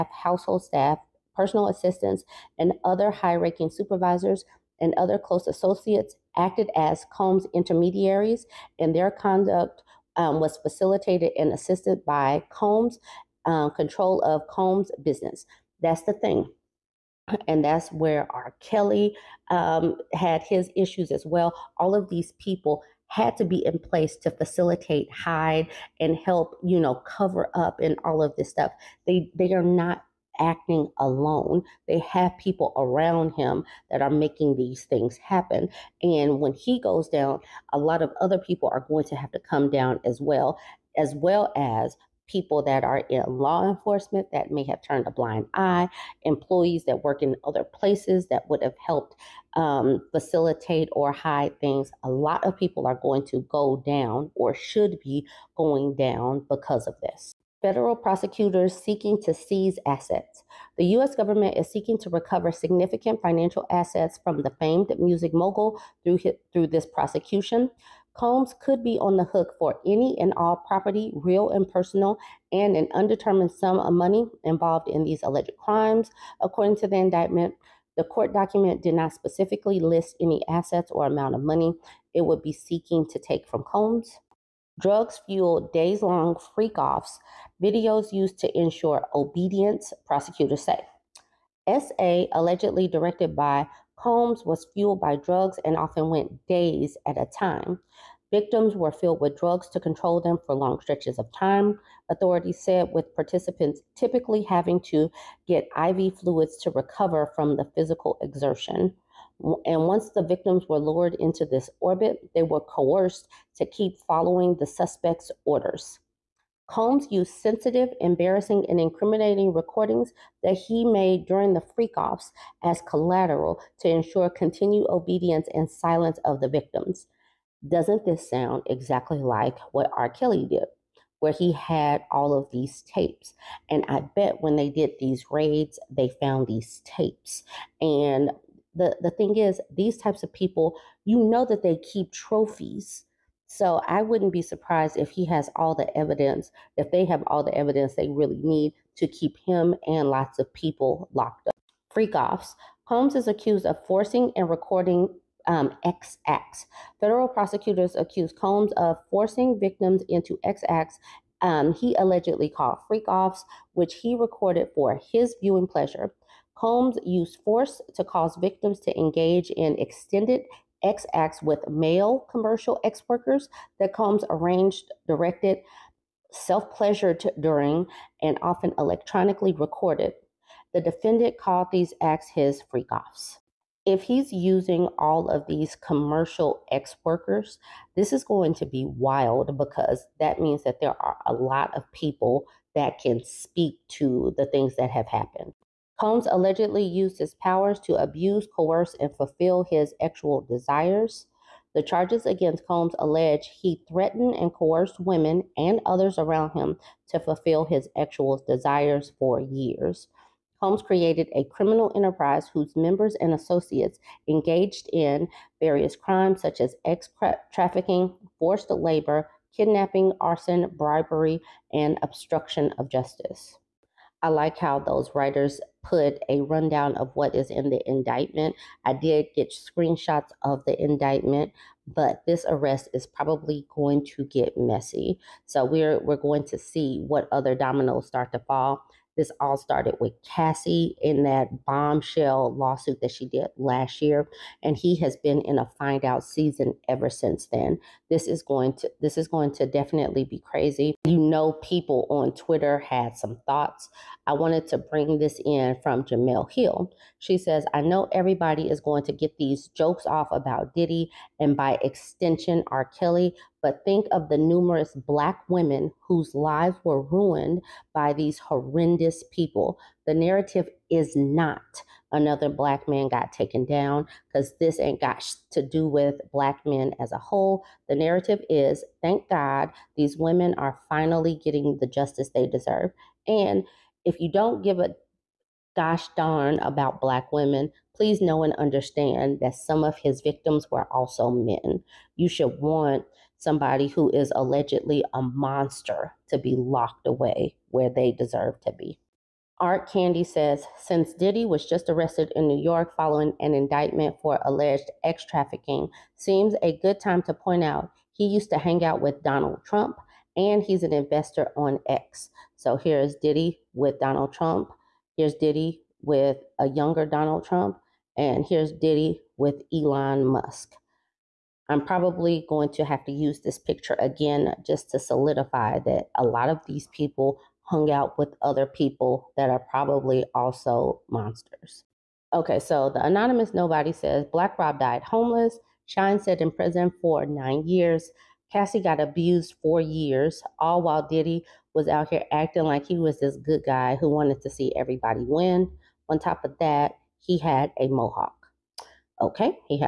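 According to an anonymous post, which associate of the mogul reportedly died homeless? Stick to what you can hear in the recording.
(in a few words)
Black Rob.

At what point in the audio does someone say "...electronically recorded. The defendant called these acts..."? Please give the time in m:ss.
2:58.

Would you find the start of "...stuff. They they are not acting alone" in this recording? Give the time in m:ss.
0:28.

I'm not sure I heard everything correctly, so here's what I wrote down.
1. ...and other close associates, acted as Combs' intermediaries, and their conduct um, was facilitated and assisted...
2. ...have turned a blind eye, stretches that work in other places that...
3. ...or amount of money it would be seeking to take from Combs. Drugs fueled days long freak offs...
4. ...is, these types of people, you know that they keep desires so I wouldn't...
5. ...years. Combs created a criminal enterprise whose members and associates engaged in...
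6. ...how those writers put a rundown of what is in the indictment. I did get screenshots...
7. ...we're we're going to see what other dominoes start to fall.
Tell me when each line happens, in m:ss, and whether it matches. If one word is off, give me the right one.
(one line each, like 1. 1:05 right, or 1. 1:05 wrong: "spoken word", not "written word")
1. 0:04 right
2. 0:44 wrong: "employees", not "stretches"
3. 1:20 right
4. 2:19 wrong: "trophies", not "desires"
5. 3:29 right
6. 3:44 right
7. 3:55 right.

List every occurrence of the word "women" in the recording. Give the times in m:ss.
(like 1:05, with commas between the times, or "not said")
3:24, 4:25, 4:40, 4:47.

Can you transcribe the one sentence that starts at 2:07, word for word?
Doesn't this sound exactly like what R.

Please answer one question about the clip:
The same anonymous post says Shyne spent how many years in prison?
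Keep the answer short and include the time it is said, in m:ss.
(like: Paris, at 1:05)
9 years, at 5:37.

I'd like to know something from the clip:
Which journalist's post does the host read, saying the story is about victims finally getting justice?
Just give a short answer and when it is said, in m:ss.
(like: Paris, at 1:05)
Jemele Hill, at 4:16.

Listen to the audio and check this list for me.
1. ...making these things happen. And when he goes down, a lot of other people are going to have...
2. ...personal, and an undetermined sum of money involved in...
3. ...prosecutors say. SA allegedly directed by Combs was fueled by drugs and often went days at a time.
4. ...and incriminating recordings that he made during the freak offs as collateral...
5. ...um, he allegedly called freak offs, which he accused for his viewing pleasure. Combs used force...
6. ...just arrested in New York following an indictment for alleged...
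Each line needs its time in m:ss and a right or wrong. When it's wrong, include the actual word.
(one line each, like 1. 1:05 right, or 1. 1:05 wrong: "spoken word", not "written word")
1. 0:34 right
2. 1:11 right
3. 1:30 right
4. 1:58 right
5. 2:41 wrong: "recorded", not "accused"
6. 5:01 right.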